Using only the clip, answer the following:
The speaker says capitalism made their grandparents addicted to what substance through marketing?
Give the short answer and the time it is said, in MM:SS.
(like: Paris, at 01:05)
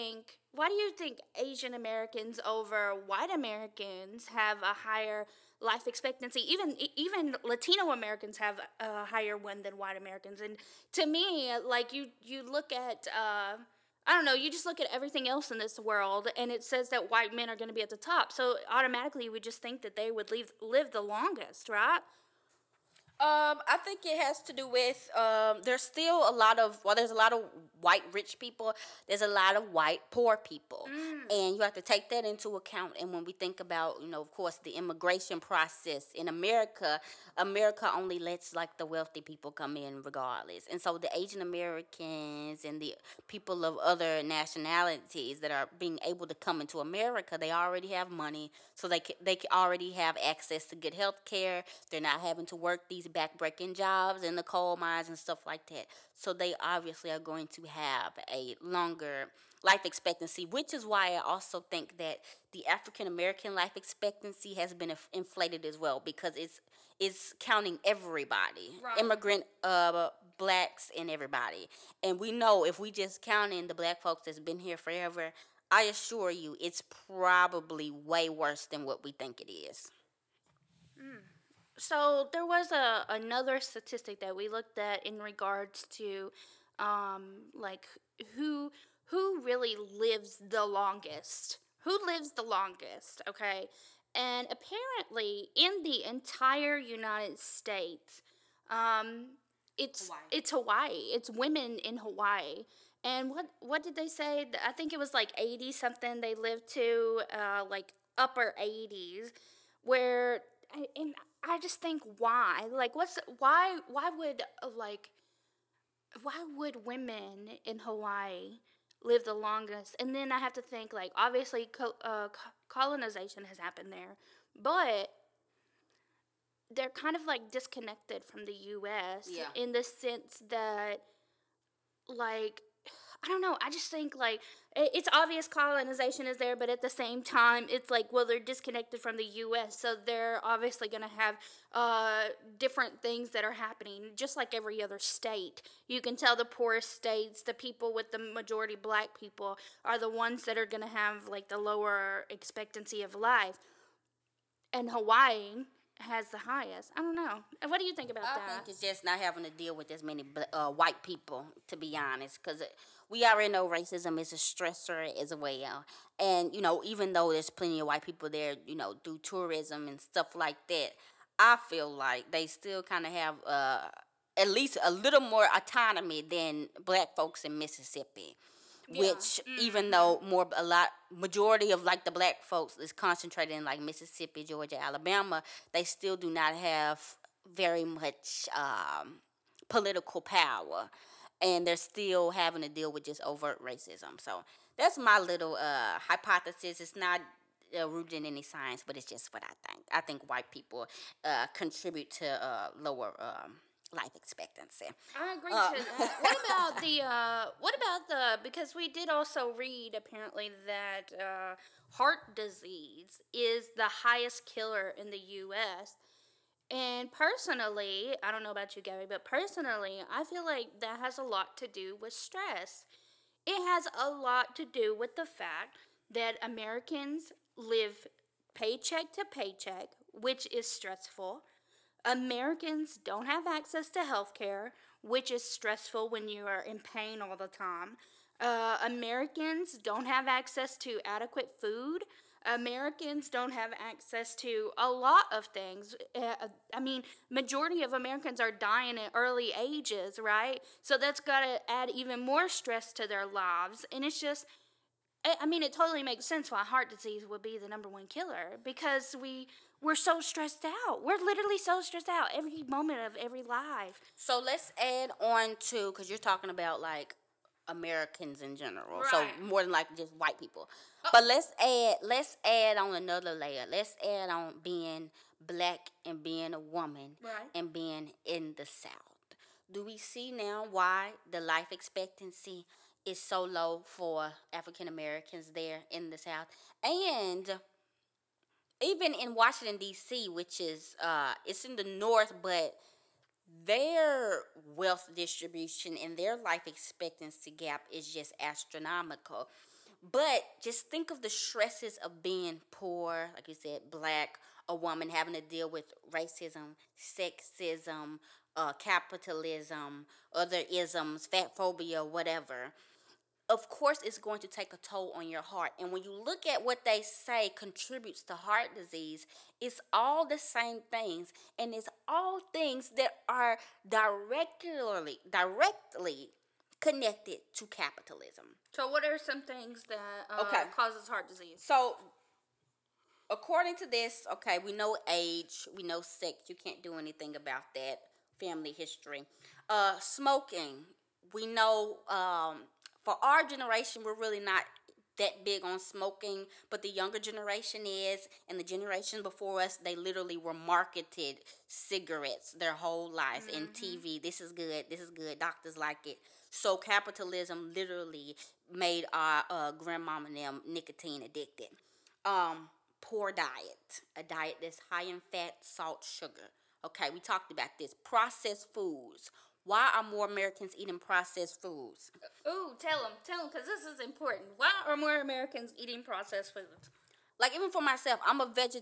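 Nicotine, at 06:00.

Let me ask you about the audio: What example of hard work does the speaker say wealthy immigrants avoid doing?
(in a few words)
Coal mines.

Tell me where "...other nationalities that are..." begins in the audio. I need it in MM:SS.
00:43.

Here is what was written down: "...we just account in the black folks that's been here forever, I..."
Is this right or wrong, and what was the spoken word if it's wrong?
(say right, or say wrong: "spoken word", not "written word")
wrong: "count", not "account".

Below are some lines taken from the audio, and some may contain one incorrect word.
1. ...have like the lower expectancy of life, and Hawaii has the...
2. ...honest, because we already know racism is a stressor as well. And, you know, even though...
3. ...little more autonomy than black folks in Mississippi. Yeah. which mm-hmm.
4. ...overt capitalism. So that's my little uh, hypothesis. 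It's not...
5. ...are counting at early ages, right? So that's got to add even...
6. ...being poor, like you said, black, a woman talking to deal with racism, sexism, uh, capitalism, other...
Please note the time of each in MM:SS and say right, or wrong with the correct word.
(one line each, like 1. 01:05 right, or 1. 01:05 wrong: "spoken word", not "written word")
1. 02:30 right
2. 02:41 right
3. 02:54 right
4. 03:13 wrong: "racism", not "capitalism"
5. 04:08 wrong: "dying", not "counting"
6. 05:02 wrong: "having", not "talking".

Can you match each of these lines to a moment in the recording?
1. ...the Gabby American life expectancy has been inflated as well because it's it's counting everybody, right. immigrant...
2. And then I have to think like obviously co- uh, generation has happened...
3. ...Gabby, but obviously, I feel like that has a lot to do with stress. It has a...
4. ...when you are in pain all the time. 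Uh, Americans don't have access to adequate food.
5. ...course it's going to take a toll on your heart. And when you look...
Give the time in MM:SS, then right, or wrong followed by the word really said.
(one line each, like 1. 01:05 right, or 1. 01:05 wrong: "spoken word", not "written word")
1. 01:02 wrong: "African", not "Gabby"
2. 01:59 wrong: "colonization", not "generation"
3. 03:38 wrong: "personally", not "obviously"
4. 03:56 right
5. 05:13 right.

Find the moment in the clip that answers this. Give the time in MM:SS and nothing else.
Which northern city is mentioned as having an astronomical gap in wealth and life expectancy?
04:49.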